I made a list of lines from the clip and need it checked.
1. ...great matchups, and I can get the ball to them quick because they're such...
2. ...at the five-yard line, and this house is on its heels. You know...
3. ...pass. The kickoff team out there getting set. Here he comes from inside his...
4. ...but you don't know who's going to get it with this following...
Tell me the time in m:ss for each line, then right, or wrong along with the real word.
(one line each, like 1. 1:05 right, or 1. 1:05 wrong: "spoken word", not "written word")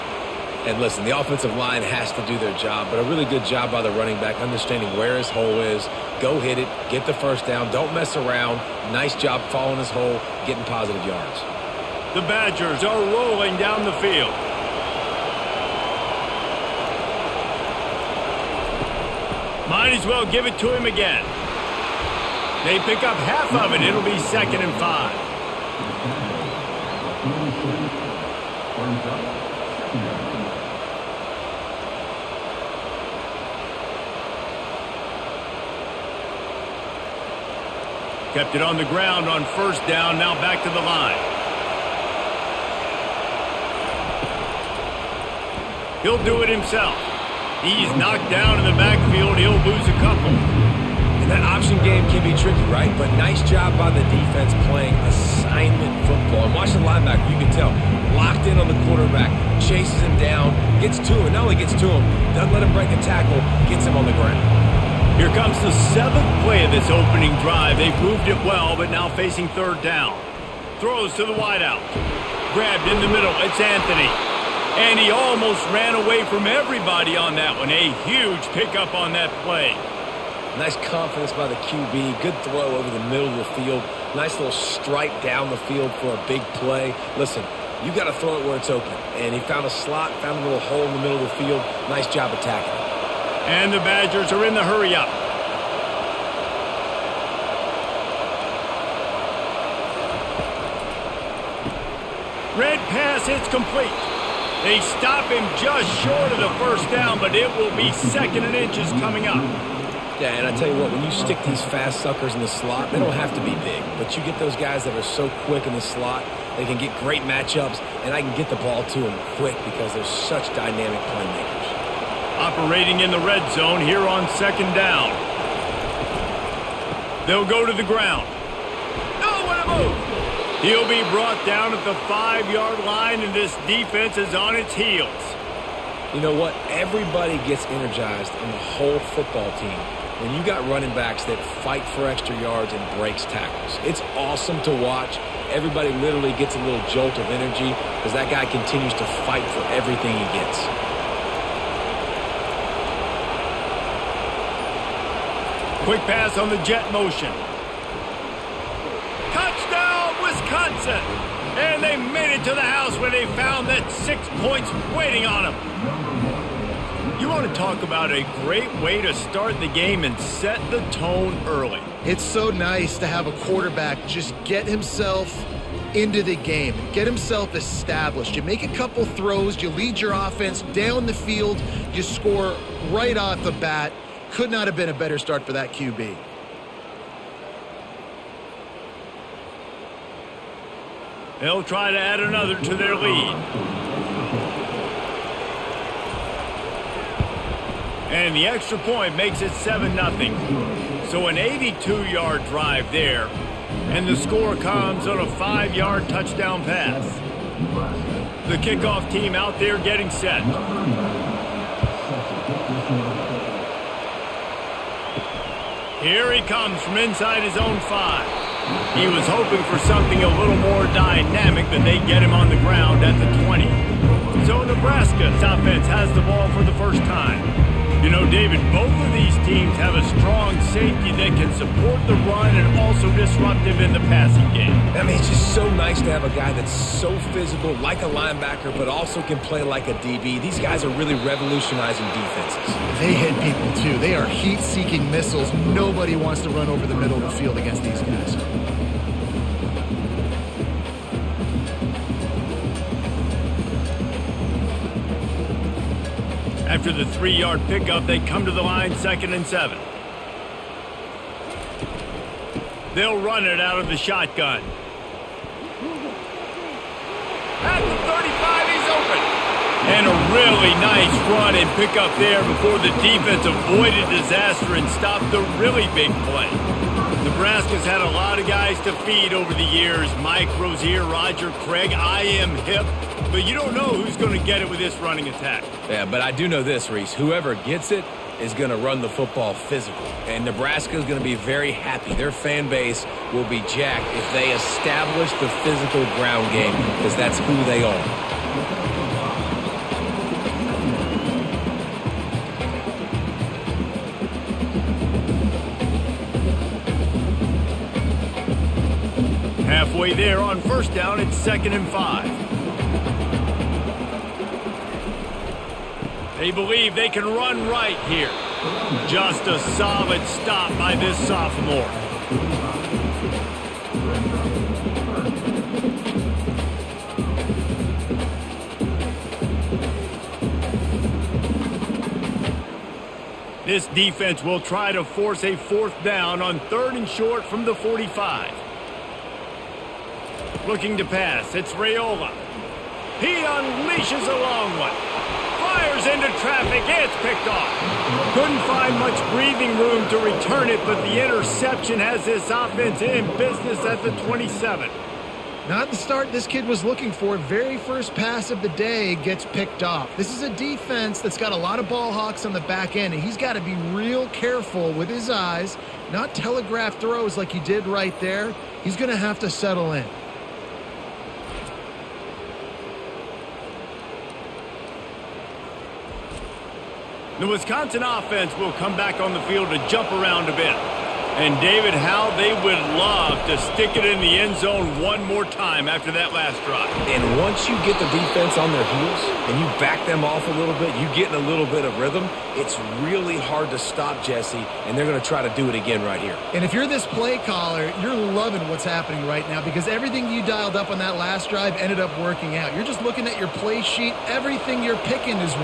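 1. 1:56 right
2. 2:11 wrong: "defense", not "house"
3. 3:26 right
4. 4:43 wrong: "running", not "following".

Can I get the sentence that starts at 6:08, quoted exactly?
He's going to have to settle in.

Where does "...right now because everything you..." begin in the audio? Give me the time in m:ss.
6:39.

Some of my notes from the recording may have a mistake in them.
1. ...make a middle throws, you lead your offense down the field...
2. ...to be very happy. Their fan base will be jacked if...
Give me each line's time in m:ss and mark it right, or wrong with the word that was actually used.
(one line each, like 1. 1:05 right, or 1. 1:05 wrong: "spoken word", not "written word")
1. 2:58 wrong: "couple", not "middle"
2. 4:51 right.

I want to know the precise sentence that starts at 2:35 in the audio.
Quick pass on the jet motion.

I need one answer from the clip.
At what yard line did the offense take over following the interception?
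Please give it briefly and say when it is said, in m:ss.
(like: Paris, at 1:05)
27, at 5:54.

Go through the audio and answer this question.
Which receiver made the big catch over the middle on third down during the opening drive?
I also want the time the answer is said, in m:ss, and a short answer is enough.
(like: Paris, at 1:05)
Anthony, at 1:13.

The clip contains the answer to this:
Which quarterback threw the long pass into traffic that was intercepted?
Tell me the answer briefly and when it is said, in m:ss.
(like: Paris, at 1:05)
Raiola, at 5:41.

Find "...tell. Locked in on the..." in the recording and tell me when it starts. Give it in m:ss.
0:57.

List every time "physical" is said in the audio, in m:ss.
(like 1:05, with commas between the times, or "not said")
3:57, 4:49, 4:55.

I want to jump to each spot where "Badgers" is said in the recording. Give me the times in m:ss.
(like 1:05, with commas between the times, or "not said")
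0:12, 1:33.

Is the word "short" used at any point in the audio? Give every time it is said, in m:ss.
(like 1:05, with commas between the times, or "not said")
1:46, 5:37.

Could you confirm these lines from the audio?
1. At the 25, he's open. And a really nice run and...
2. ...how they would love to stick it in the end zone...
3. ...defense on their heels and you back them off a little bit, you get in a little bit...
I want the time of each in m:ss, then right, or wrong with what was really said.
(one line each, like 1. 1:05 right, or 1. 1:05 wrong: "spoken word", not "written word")
1. 4:27 wrong: "35", not "25"
2. 6:21 right
3. 6:28 right.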